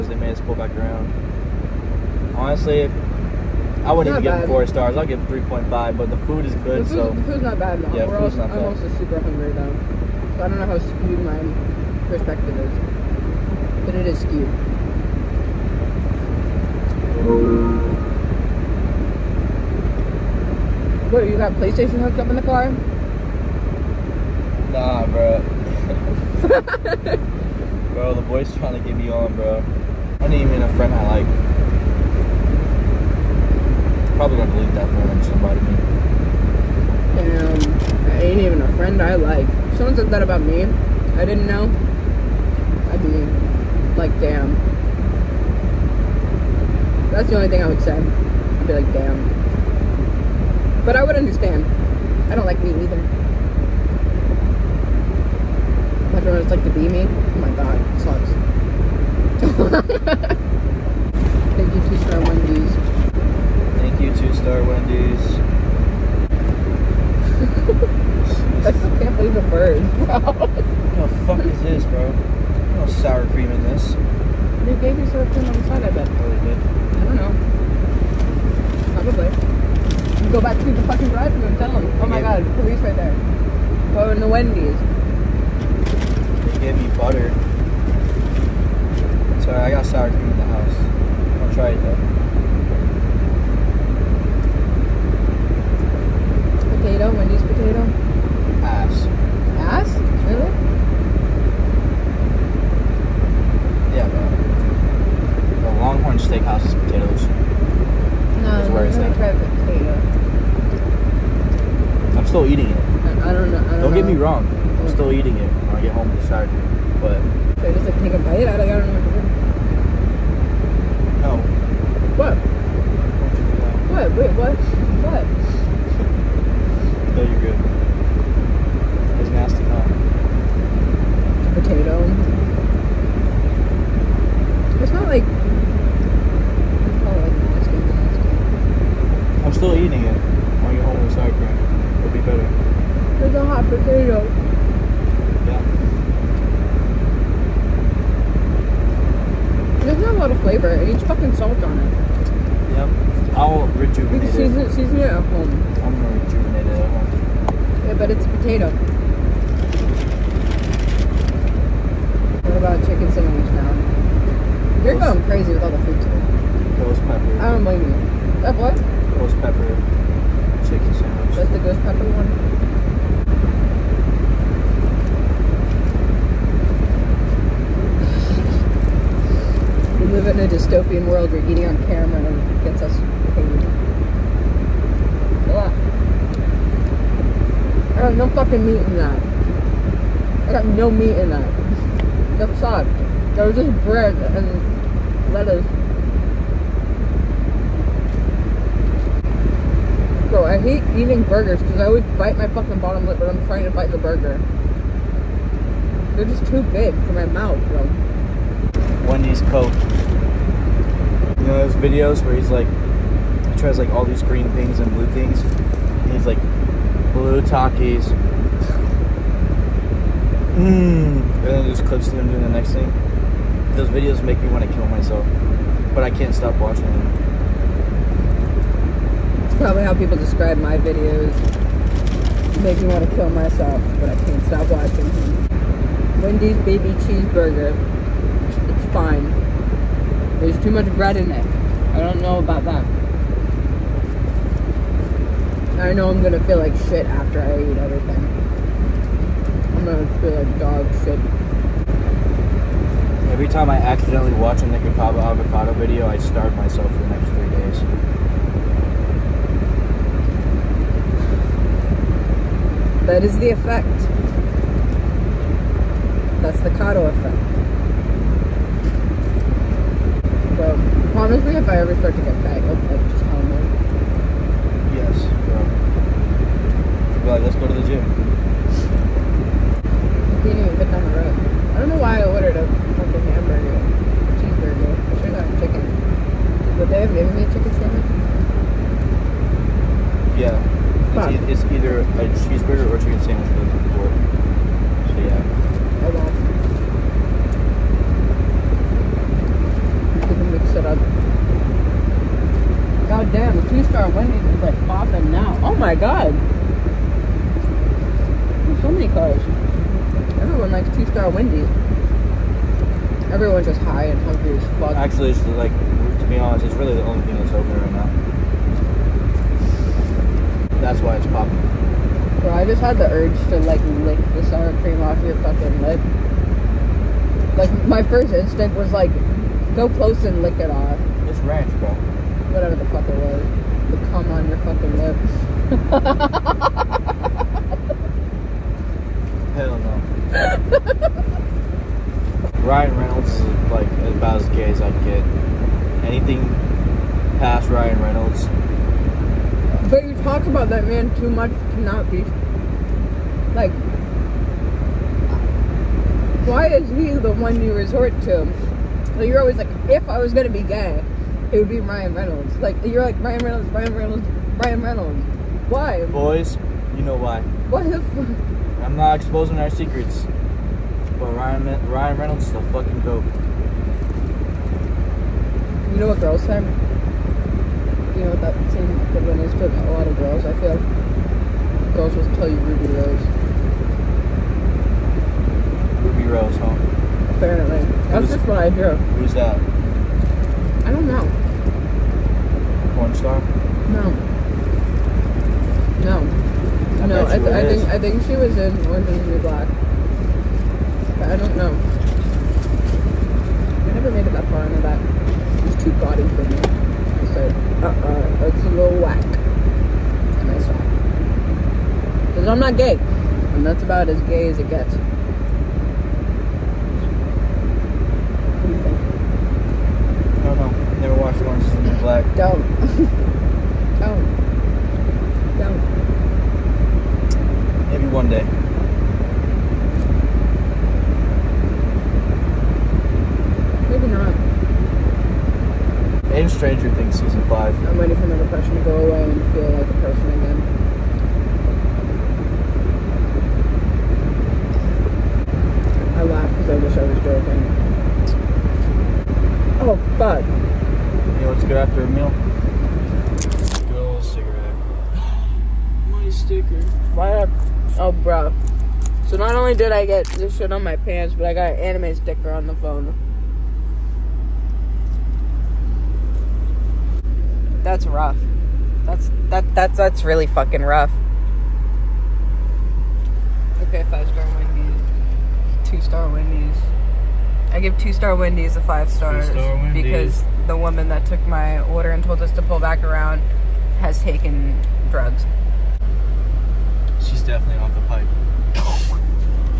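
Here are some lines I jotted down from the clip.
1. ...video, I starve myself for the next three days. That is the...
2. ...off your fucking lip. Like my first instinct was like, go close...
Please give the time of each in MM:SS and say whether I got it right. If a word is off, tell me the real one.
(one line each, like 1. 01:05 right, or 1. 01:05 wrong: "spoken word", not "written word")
1. 04:15 right
2. 05:25 right.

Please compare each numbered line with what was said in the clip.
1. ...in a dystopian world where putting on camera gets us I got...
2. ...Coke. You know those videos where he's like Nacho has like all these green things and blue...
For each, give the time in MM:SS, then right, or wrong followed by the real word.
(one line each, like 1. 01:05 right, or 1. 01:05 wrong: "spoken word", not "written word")
1. 03:00 wrong: "eating", not "putting"
2. 03:29 right.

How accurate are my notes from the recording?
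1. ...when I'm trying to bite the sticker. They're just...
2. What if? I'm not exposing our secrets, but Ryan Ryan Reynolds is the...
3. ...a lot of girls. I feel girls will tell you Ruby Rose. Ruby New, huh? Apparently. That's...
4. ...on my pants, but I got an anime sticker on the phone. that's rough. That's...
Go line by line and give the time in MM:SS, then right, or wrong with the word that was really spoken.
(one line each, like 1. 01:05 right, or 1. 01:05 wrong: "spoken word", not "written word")
1. 03:23 wrong: "burger", not "sticker"
2. 06:07 right
3. 06:19 wrong: "Rose", not "New"
4. 07:40 right.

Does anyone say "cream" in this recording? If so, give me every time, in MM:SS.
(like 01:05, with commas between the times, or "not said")
05:24.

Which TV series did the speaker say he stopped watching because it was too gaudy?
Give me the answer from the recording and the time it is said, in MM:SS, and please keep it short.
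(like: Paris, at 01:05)
Orange is the New Black, at 06:38.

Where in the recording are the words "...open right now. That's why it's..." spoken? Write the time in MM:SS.
05:17.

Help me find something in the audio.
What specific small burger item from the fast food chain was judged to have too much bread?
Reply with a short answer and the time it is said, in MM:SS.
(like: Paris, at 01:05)
Wendy's baby cheeseburger, at 03:56.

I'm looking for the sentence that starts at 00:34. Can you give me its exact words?
Probably gonna delete that phone and somebody.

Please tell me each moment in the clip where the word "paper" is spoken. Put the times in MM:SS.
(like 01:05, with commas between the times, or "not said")
not said.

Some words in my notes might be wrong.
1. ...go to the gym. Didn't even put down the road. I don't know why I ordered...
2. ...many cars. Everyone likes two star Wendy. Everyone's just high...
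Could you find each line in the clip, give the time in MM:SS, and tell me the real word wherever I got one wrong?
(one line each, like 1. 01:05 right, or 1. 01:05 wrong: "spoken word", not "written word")
1. 04:37 right
2. 05:08 right.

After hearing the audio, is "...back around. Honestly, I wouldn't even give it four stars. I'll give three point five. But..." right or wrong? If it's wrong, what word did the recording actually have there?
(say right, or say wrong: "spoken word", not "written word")
right.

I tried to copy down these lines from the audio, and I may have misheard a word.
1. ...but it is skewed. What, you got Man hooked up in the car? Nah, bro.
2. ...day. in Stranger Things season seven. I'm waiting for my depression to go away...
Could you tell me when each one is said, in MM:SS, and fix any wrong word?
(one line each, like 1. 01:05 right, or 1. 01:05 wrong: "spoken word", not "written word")
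1. 00:13 wrong: "PlayStation", not "Man"
2. 07:08 wrong: "five", not "seven".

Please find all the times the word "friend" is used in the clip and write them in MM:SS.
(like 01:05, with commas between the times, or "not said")
00:30, 00:38.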